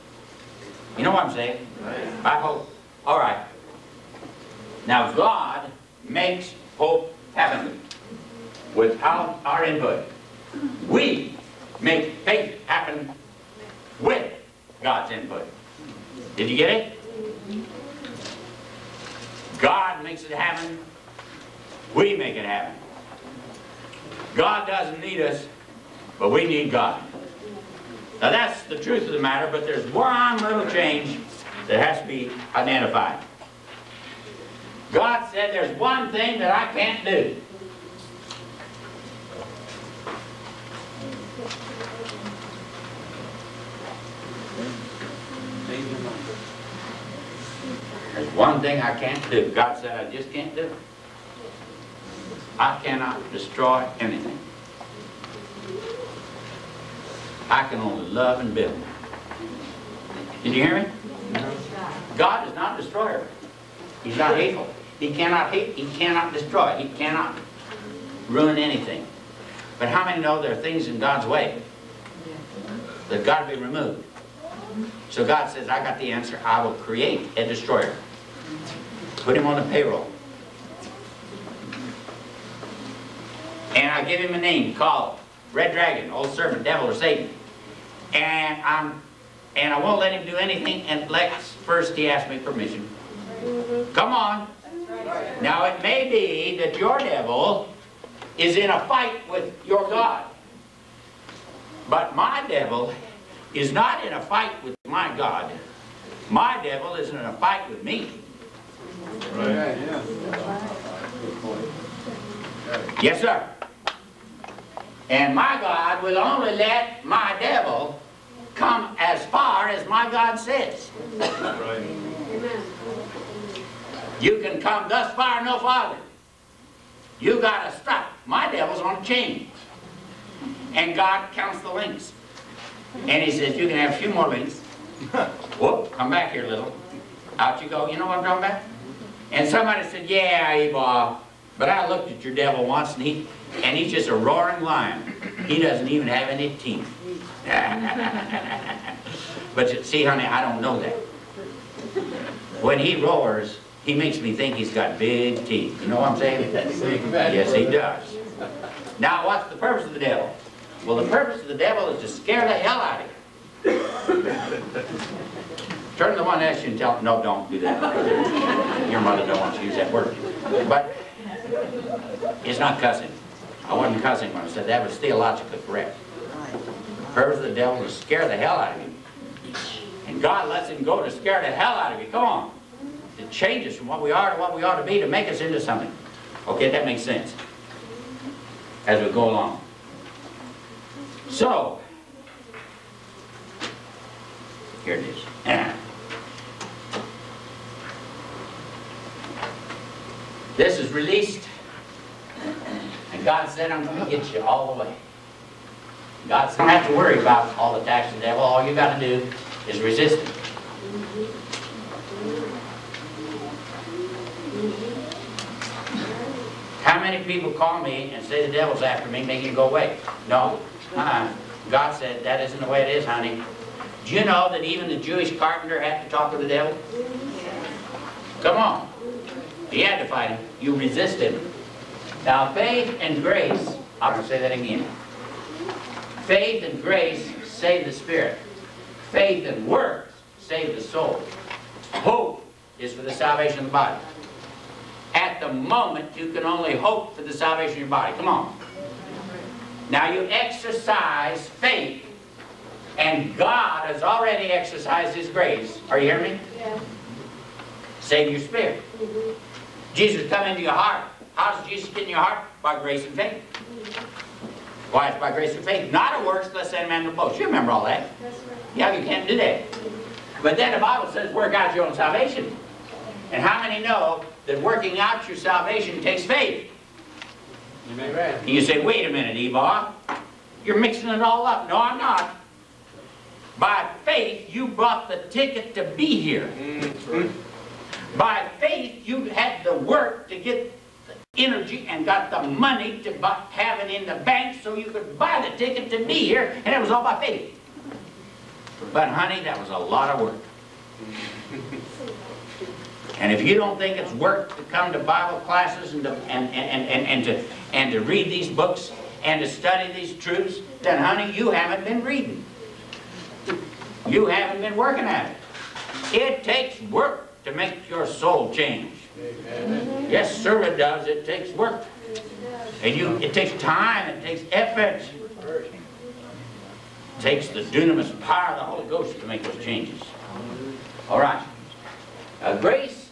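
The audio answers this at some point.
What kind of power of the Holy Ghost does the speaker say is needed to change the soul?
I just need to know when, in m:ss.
5:27.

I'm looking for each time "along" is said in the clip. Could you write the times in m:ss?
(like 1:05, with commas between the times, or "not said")
3:09.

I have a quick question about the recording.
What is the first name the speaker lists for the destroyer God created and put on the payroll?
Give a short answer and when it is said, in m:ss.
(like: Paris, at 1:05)
Red Dragon, at 1:25.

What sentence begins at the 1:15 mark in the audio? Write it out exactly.
So God says, I got the answer.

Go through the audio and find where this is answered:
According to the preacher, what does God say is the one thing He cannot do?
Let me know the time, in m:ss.
0:53.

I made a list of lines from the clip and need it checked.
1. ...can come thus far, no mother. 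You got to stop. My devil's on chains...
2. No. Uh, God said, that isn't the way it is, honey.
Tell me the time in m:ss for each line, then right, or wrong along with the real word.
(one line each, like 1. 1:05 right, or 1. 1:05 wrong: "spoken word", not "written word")
1. 2:04 wrong: "farther", not "mother"
2. 3:40 right.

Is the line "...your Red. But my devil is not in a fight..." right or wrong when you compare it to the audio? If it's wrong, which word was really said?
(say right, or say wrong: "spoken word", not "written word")
wrong: "God", not "Red".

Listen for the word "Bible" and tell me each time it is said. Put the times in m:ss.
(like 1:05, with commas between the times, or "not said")
4:30, 5:04.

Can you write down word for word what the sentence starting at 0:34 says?
God said there's one thing that I can't do.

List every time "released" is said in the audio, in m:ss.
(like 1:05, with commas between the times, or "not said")
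3:20.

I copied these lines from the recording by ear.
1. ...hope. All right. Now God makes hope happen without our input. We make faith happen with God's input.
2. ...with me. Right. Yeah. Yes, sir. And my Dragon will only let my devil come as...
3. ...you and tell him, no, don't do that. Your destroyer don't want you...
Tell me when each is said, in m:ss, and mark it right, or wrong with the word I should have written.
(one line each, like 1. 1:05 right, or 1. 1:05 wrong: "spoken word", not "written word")
1. 0:02 right
2. 1:47 wrong: "God", not "Dragon"
3. 2:46 wrong: "mother", not "destroyer".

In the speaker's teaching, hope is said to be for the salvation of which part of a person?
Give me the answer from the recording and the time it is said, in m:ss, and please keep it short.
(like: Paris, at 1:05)
The body, at 4:03.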